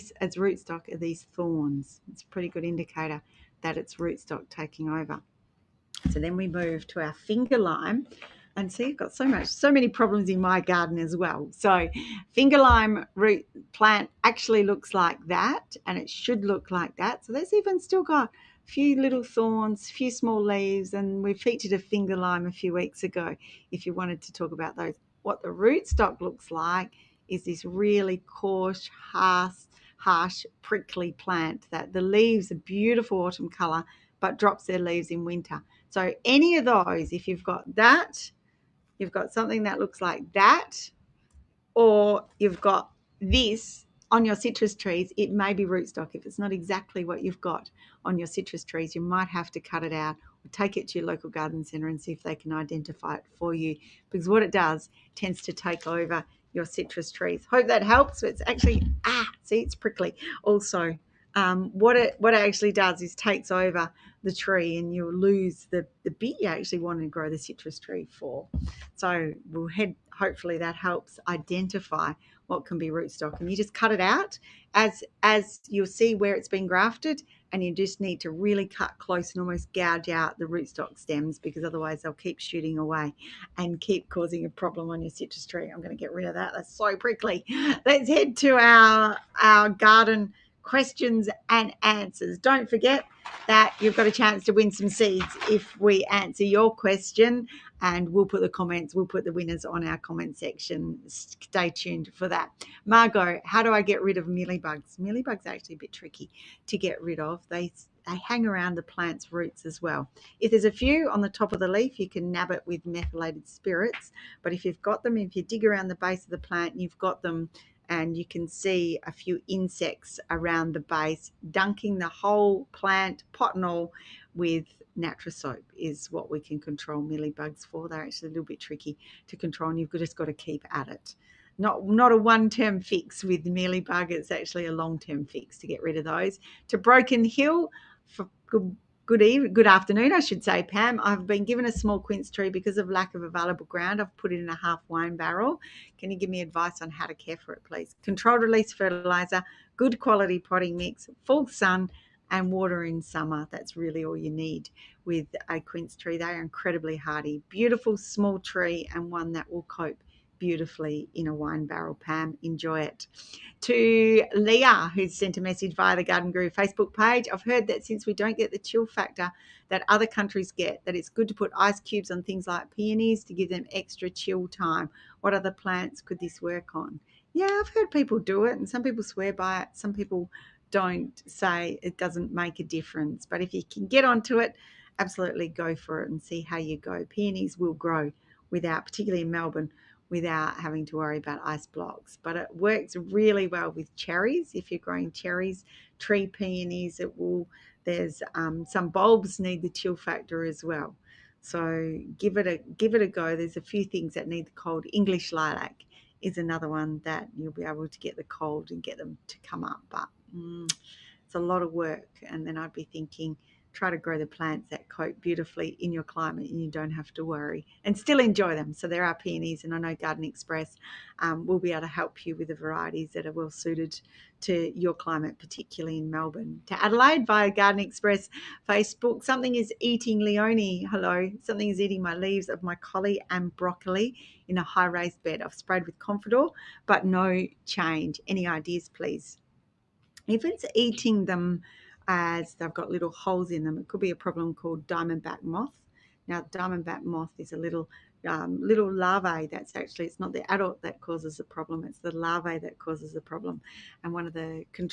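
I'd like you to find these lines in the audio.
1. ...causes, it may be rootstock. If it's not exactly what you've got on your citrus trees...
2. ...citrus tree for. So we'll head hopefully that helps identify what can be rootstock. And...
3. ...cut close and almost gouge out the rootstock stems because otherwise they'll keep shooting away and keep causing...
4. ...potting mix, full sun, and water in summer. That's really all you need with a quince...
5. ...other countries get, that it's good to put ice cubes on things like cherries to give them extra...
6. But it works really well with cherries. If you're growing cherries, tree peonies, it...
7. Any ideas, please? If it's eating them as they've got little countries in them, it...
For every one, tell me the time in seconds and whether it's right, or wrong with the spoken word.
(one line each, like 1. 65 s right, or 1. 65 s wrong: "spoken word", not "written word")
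1. 44 s wrong: "trees", not "causes"
2. 67 s right
3. 78 s right
4. 150 s right
5. 169 s wrong: "peonies", not "cherries"
6. 192 s right
7. 238 s wrong: "holes", not "countries".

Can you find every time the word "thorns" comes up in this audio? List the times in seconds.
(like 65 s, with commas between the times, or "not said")
1 s, 19 s.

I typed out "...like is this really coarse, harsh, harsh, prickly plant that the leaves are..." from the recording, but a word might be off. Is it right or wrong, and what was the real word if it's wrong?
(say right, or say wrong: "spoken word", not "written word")
right.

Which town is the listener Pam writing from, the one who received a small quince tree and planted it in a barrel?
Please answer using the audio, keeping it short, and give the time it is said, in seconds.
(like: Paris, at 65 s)
Broken Hill, at 136 s.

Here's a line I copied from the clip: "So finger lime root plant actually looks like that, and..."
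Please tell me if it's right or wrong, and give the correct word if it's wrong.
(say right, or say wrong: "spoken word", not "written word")
right.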